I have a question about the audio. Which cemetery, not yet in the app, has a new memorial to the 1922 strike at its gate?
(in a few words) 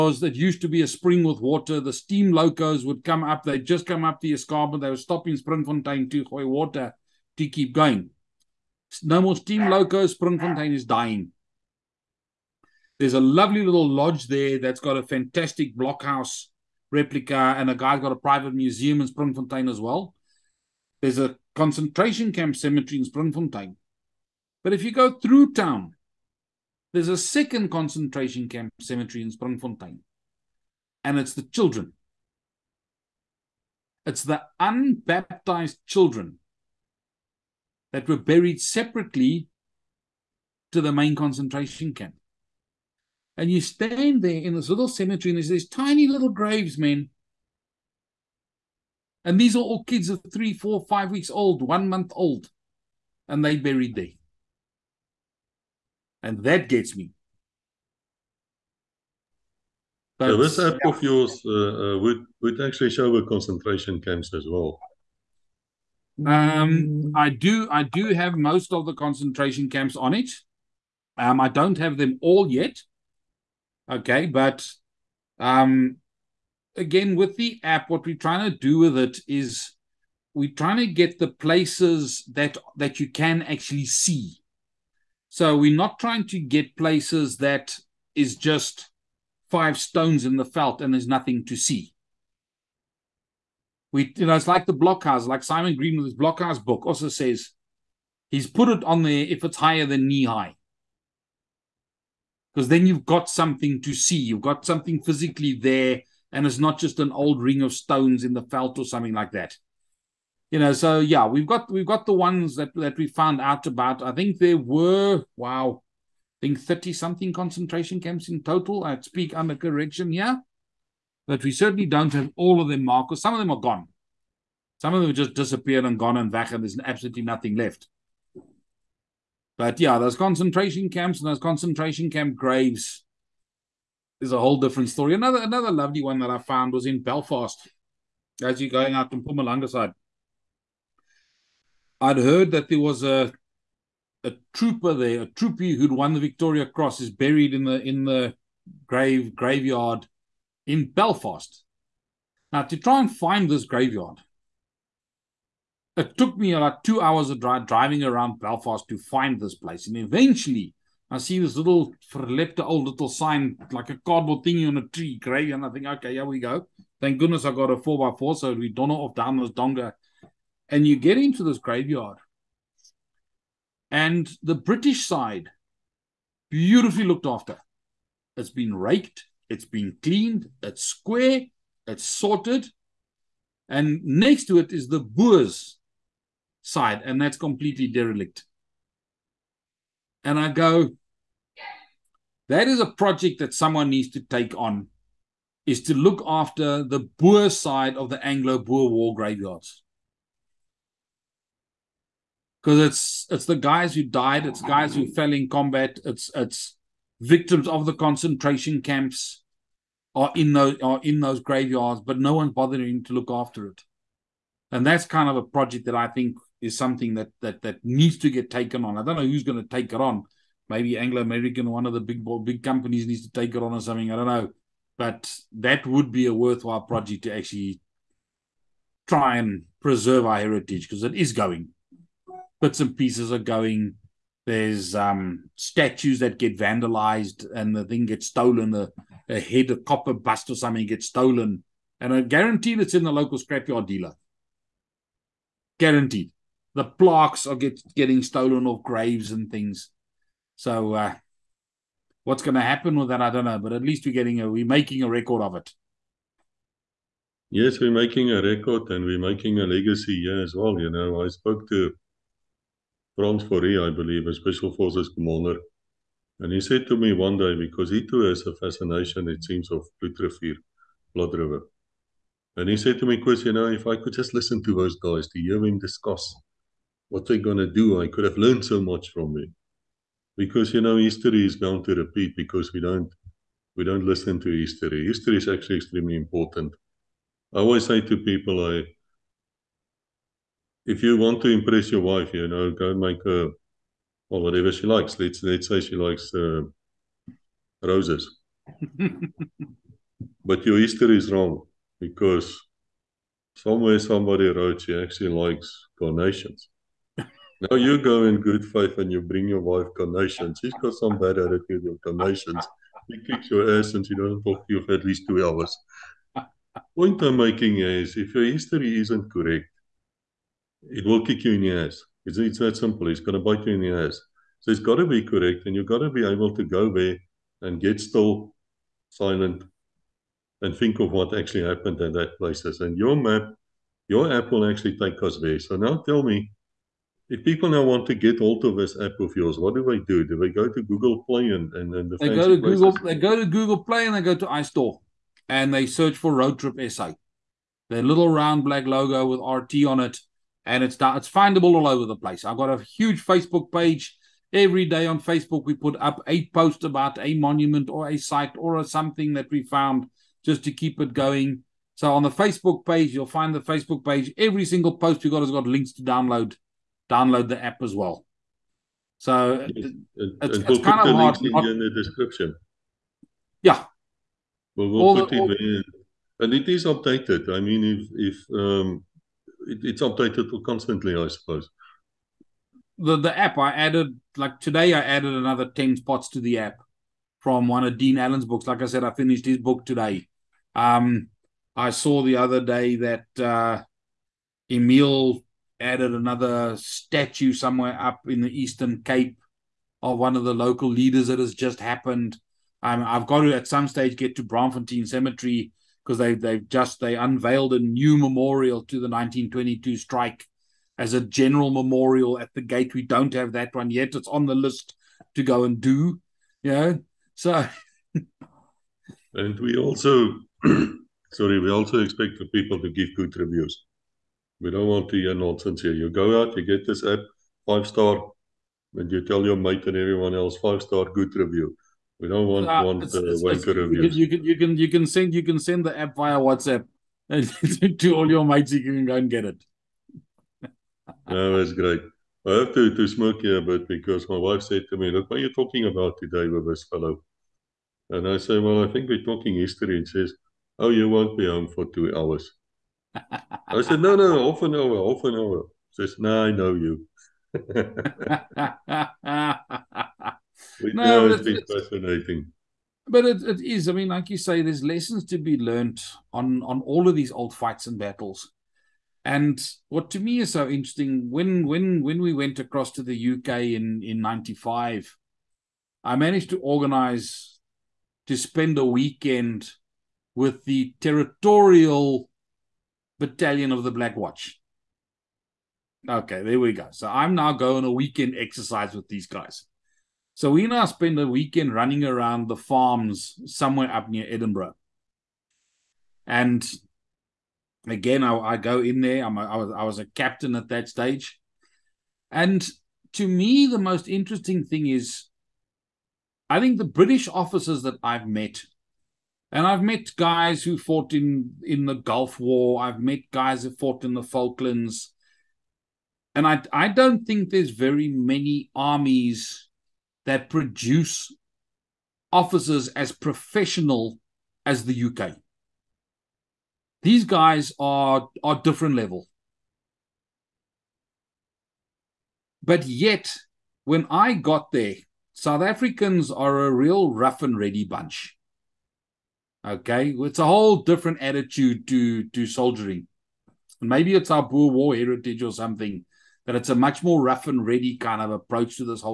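Braamfontein Cemetery.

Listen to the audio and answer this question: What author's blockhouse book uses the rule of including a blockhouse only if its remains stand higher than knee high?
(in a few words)
Simon Green.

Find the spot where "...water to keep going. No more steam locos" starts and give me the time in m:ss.
0:06.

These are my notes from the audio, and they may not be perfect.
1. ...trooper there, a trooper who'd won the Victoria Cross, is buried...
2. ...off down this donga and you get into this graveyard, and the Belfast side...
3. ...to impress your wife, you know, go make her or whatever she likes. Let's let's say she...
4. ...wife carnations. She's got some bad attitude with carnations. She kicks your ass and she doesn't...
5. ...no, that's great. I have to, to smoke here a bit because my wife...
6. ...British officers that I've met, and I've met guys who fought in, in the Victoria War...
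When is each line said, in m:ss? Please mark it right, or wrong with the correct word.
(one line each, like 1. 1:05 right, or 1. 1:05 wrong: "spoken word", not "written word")
1. 2:24 right
2. 2:48 wrong: "British", not "Belfast"
3. 4:51 right
4. 5:09 right
5. 7:21 right
6. 8:26 wrong: "Gulf", not "Victoria".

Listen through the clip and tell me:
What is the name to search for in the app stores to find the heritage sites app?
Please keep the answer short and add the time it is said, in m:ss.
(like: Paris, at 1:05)
Road Trip SA, at 5:46.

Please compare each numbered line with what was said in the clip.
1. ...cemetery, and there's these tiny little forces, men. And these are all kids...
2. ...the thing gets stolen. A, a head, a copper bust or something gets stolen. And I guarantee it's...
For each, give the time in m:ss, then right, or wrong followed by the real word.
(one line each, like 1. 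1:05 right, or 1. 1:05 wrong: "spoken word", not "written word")
1. 0:44 wrong: "graves", not "forces"
2. 3:57 right.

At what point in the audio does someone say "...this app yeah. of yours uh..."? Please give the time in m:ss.
1:00.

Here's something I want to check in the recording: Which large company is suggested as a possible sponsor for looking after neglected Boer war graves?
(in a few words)
Anglo American.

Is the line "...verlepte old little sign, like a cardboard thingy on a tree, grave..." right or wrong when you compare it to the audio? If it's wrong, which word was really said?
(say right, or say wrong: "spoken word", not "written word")
right.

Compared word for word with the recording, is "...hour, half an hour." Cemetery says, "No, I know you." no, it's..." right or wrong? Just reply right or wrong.
wrong.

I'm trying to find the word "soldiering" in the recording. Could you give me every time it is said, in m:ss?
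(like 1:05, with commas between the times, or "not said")
9:02.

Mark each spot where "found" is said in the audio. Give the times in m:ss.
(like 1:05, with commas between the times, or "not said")
1:53, 2:16, 5:59.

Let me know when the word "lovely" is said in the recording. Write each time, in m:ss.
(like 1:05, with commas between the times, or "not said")
0:13, 2:15.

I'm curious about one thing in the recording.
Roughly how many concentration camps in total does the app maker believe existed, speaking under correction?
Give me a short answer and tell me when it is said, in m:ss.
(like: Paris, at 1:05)
30 something, at 1:56.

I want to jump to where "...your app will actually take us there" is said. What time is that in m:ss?
5:34.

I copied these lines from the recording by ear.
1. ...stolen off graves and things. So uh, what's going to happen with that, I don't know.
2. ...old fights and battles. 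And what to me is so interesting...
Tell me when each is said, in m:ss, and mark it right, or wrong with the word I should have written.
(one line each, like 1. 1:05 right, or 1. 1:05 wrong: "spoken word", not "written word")
1. 4:08 right
2. 7:47 right.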